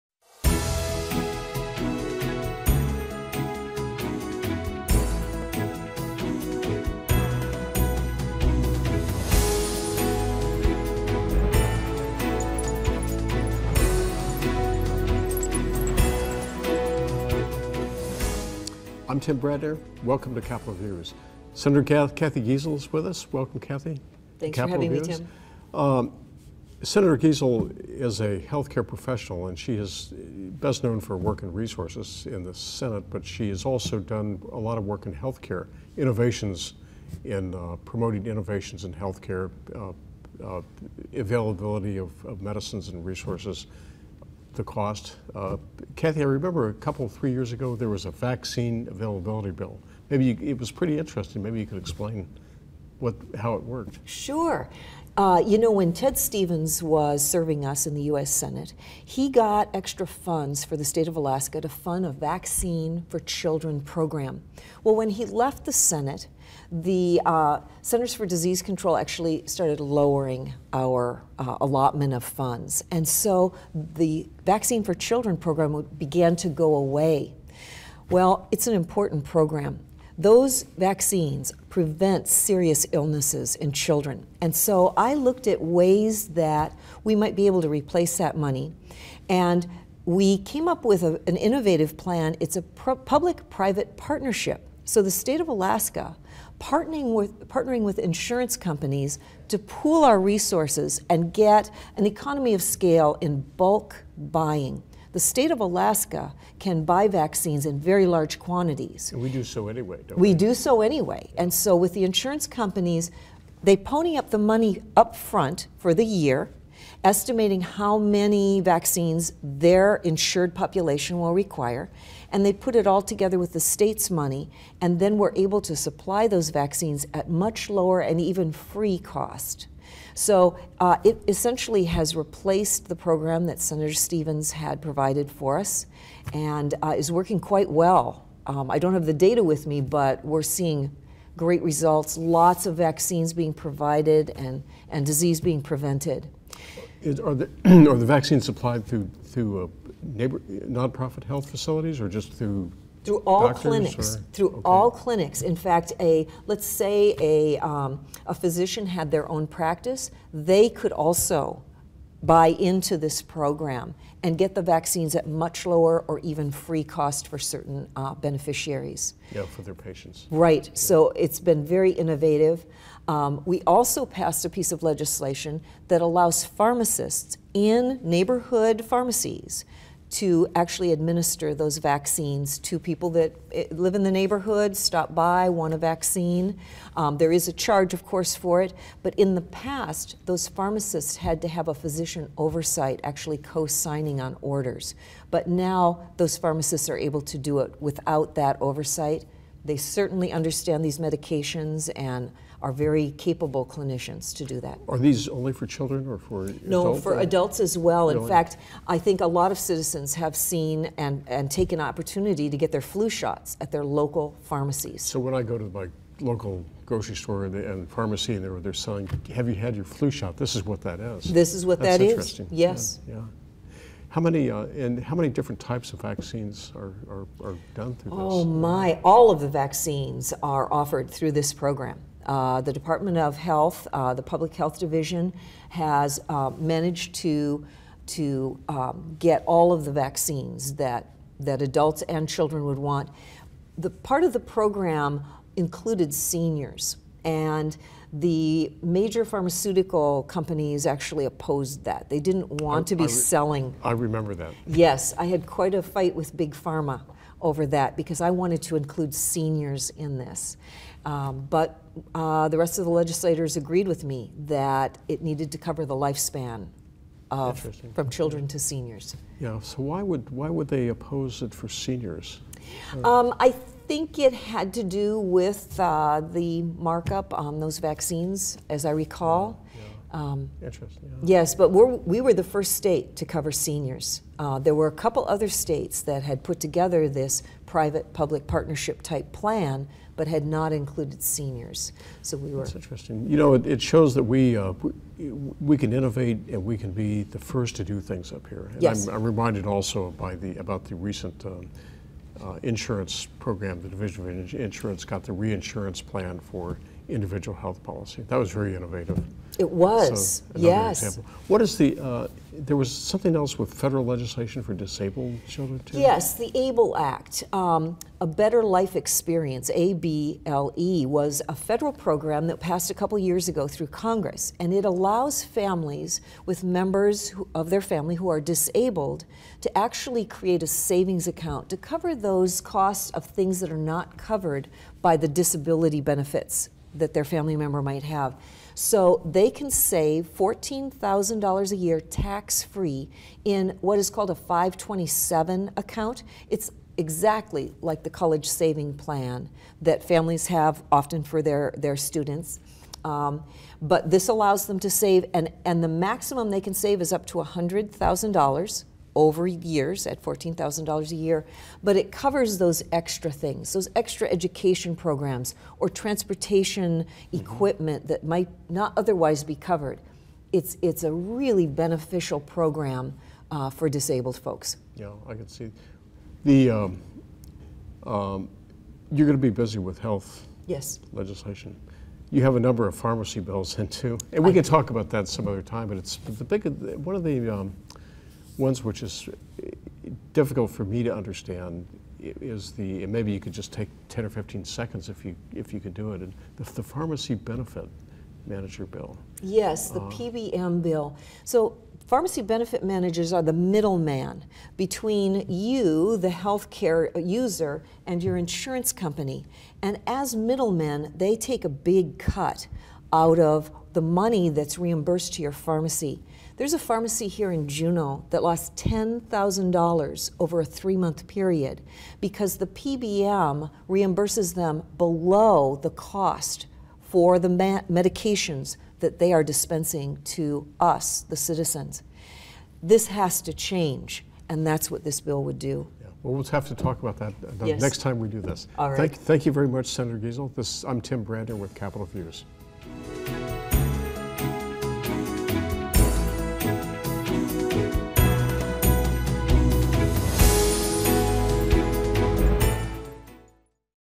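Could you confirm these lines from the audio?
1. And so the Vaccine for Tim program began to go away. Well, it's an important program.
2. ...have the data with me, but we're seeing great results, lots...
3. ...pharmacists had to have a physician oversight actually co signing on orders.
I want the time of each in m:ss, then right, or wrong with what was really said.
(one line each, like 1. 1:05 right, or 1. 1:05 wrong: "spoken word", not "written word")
1. 1:12 wrong: "Children", not "Tim"
2. 2:18 right
3. 3:10 right.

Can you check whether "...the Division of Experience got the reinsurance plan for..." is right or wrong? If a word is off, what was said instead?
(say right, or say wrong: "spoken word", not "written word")
wrong: "Insurance", not "Experience".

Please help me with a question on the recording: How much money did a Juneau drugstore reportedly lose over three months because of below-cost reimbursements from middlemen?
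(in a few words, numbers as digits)
$10,000.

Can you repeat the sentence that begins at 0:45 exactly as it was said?
Uh, Cathy, I remember a couple, three years ago, there was a vaccine availability bill.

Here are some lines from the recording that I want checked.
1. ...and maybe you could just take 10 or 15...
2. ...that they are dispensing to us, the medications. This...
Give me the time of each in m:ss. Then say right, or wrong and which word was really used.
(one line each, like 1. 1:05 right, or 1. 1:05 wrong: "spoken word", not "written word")
1. 6:33 right
2. 7:08 wrong: "citizens", not "medications".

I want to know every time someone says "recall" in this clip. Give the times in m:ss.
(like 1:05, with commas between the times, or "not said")
4:38.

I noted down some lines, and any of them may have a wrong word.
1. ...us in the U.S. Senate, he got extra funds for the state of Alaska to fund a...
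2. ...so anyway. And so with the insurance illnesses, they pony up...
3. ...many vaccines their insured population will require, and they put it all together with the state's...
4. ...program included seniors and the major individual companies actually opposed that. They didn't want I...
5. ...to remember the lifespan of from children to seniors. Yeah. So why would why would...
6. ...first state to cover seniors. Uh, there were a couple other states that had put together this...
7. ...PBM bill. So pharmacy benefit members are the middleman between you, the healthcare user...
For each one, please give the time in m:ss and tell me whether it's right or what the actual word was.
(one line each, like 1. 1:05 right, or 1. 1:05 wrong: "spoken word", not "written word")
1. 0:57 right
2. 1:50 wrong: "companies", not "illnesses"
3. 1:57 right
4. 4:04 wrong: "pharmaceutical", not "individual"
5. 4:25 wrong: "cover", not "remember"
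6. 4:42 right
7. 6:40 wrong: "managers", not "members".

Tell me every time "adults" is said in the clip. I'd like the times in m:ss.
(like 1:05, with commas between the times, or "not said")
3:27, 4:01.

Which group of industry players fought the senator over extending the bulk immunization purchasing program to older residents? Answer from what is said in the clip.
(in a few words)
Big Pharma.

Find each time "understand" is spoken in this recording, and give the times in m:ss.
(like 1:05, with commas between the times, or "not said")
3:20, 6:31.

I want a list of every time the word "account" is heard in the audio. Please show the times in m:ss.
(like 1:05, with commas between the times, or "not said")
5:31, 5:45.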